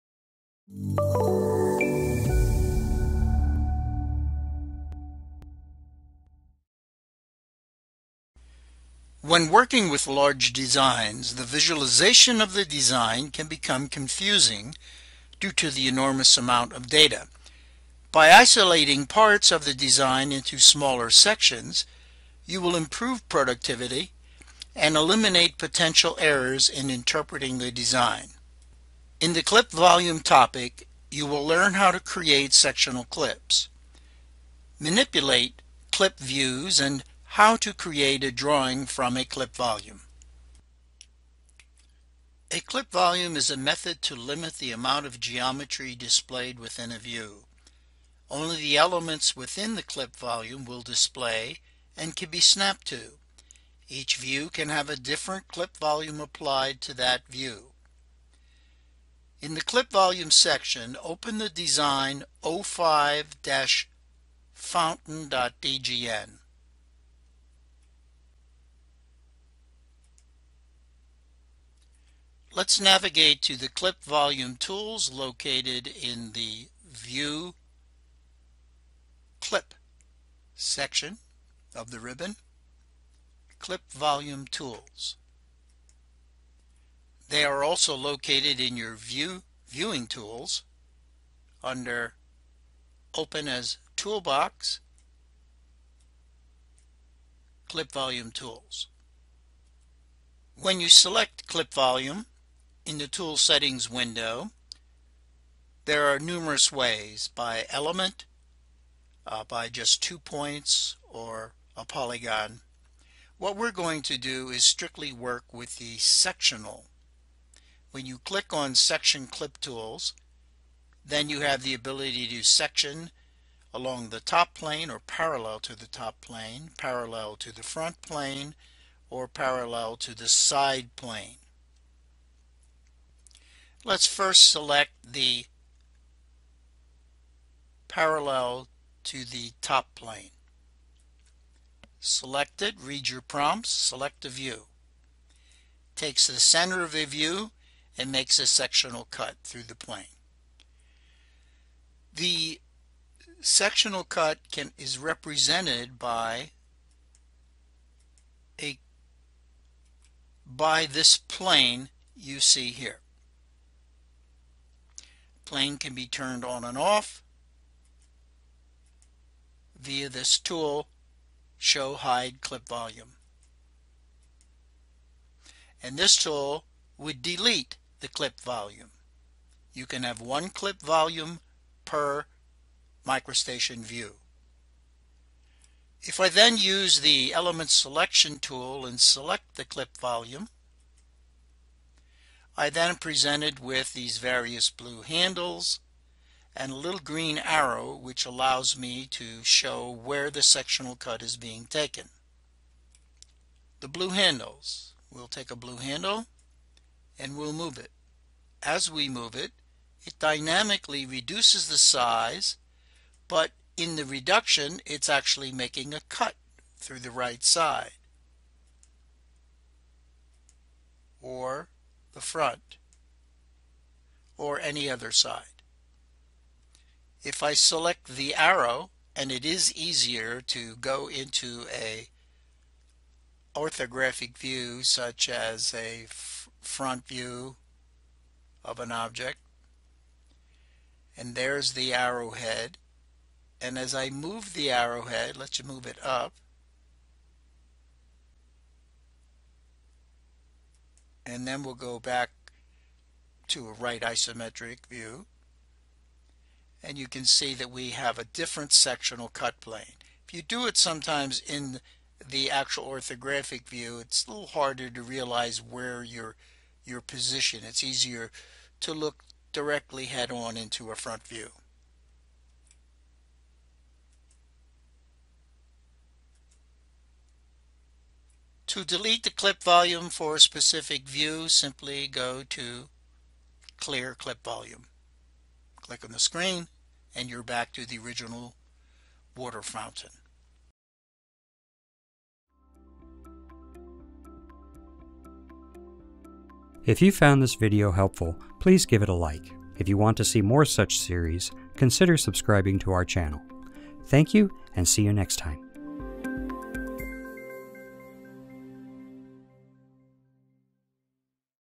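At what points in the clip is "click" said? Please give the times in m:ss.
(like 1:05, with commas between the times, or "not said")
1:58, 4:45.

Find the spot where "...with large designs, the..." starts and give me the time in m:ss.
0:09.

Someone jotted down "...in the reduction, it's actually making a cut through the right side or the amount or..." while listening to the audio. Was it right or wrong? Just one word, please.
wrong.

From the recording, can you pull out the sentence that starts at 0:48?
Only the elements within the clip volume will display and can be snapped to.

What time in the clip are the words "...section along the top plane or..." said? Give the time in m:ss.
2:02.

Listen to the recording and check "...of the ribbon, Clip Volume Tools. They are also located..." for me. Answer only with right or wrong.
right.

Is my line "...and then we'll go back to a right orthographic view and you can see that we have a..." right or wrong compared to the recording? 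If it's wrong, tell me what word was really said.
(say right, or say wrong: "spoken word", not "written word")
wrong: "isometric", not "orthographic".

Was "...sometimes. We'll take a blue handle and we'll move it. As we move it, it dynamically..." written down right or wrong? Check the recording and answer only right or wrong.
wrong.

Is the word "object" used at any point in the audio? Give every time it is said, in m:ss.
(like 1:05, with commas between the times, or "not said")
3:58.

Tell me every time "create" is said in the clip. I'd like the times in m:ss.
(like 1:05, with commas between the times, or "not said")
0:31, 0:37.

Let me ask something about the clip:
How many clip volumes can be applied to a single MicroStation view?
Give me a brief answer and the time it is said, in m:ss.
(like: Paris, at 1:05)
1, at 3:00.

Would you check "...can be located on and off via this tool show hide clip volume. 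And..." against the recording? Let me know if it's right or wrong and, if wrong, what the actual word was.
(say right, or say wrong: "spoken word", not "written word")
wrong: "turned", not "located".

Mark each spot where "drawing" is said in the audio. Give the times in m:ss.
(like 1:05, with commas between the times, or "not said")
0:38.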